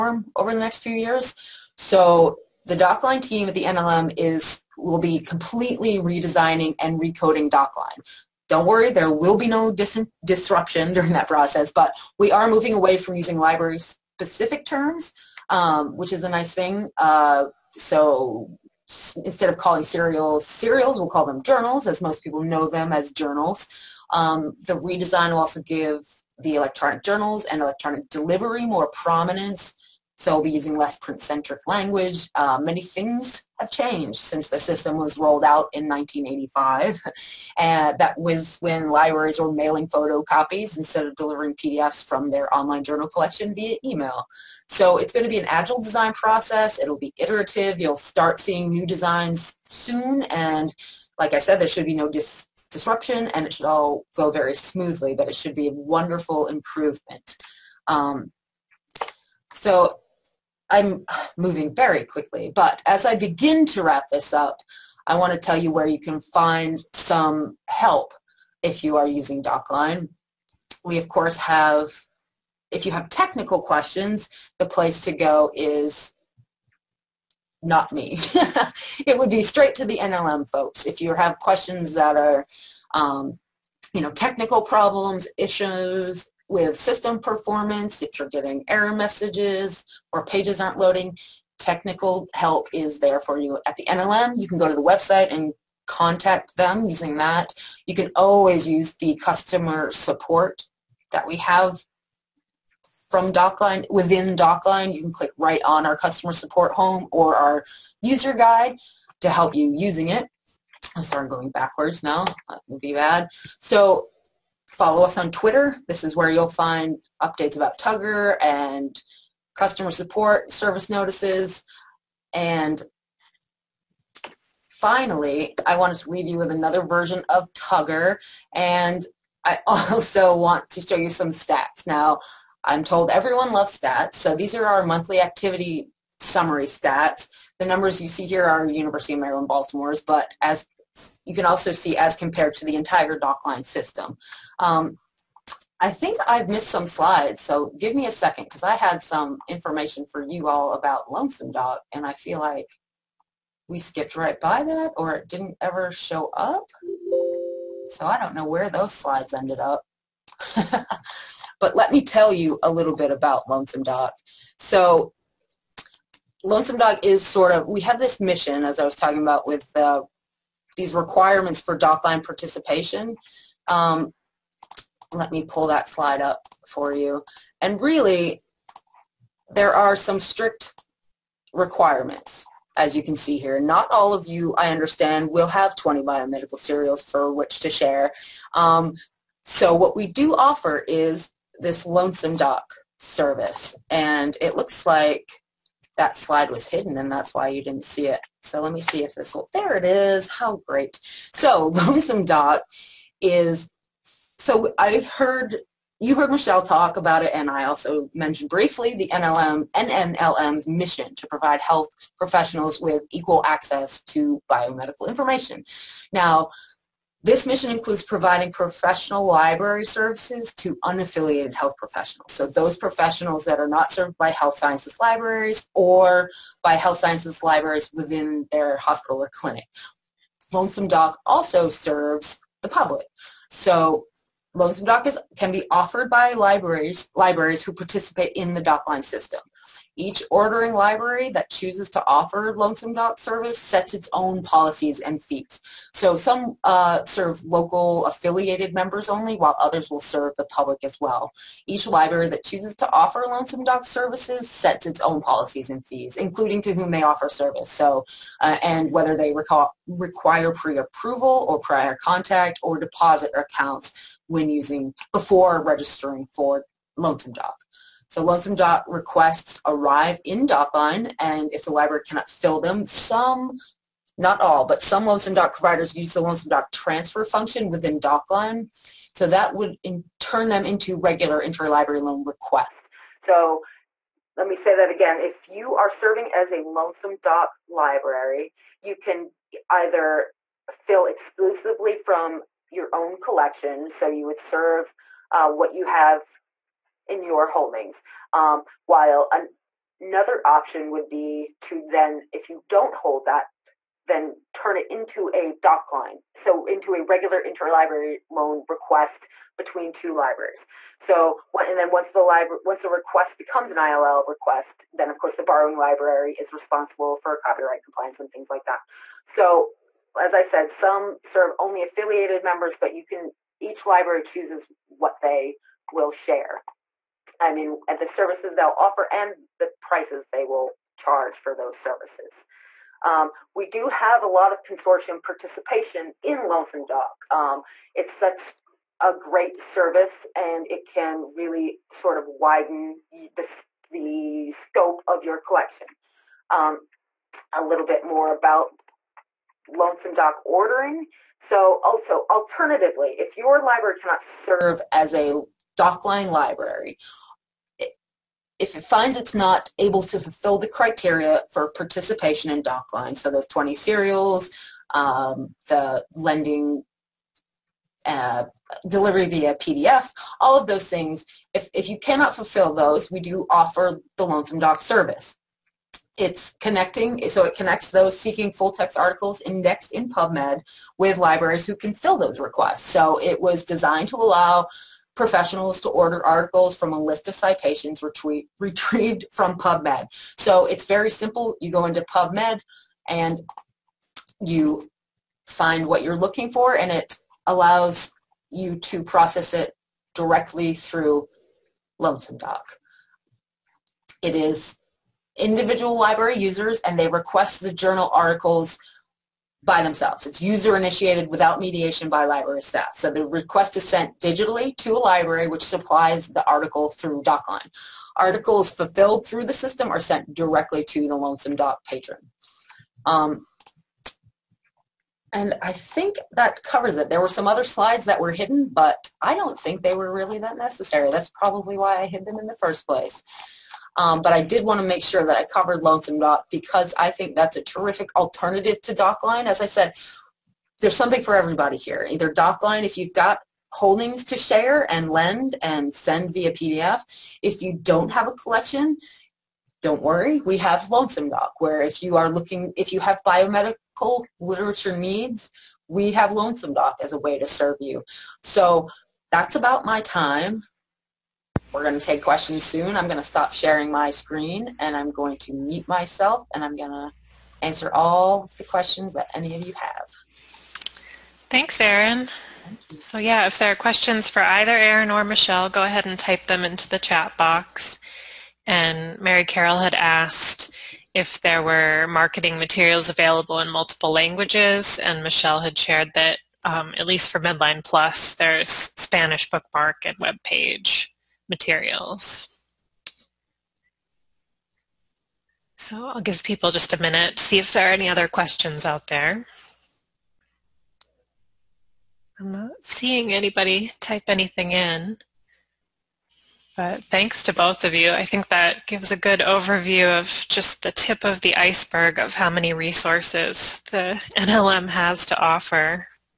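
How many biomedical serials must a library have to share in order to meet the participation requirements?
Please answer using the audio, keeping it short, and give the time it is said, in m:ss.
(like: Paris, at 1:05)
20, at 3:05.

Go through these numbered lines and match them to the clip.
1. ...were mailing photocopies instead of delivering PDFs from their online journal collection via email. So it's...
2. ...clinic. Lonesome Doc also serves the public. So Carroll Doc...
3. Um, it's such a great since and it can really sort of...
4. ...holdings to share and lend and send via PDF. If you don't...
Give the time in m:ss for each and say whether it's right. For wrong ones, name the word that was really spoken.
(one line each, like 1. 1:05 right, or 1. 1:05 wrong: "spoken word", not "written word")
1. 0:39 right
2. 3:49 wrong: "Lonesome", not "Carroll"
3. 5:37 wrong: "service", not "since"
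4. 7:23 right.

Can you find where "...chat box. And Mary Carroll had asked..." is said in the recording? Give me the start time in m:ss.
7:57.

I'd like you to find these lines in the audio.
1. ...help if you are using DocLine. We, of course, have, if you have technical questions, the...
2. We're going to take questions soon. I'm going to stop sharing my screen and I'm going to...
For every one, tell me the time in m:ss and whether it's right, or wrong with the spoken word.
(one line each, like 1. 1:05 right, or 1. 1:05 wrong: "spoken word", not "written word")
1. 1:07 right
2. 7:41 right.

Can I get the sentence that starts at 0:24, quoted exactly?
Um, the redesign will also give the electronic journals and electronic delivery more prominence.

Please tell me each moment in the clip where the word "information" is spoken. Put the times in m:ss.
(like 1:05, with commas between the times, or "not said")
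2:29, 3:35.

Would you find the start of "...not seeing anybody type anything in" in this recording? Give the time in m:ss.
8:22.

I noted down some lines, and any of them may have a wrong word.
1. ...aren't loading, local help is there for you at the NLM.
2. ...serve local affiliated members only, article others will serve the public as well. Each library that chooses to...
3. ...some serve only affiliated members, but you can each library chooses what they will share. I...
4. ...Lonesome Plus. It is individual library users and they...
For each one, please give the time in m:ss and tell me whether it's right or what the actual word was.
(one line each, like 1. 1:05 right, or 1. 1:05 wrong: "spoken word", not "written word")
1. 1:30 wrong: "technical", not "local"
2. 4:07 wrong: "while", not "article"
3. 5:20 right
4. 6:41 wrong: "Doc", not "Plus".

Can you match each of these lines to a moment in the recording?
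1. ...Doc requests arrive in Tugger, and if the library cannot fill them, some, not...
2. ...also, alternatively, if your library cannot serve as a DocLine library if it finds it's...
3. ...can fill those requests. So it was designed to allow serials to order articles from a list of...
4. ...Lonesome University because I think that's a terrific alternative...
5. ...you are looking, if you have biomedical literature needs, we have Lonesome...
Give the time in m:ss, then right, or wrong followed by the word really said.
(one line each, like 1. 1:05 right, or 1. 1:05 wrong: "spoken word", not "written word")
1. 4:28 wrong: "DocLine", not "Tugger"
2. 5:51 right
3. 6:21 wrong: "professionals", not "serials"
4. 7:15 wrong: "Doc", not "University"
5. 7:32 right.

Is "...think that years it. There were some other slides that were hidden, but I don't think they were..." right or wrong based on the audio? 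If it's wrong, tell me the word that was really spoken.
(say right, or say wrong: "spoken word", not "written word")
wrong: "covers", not "years".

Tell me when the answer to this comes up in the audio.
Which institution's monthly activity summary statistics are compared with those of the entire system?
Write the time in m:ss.
2:18.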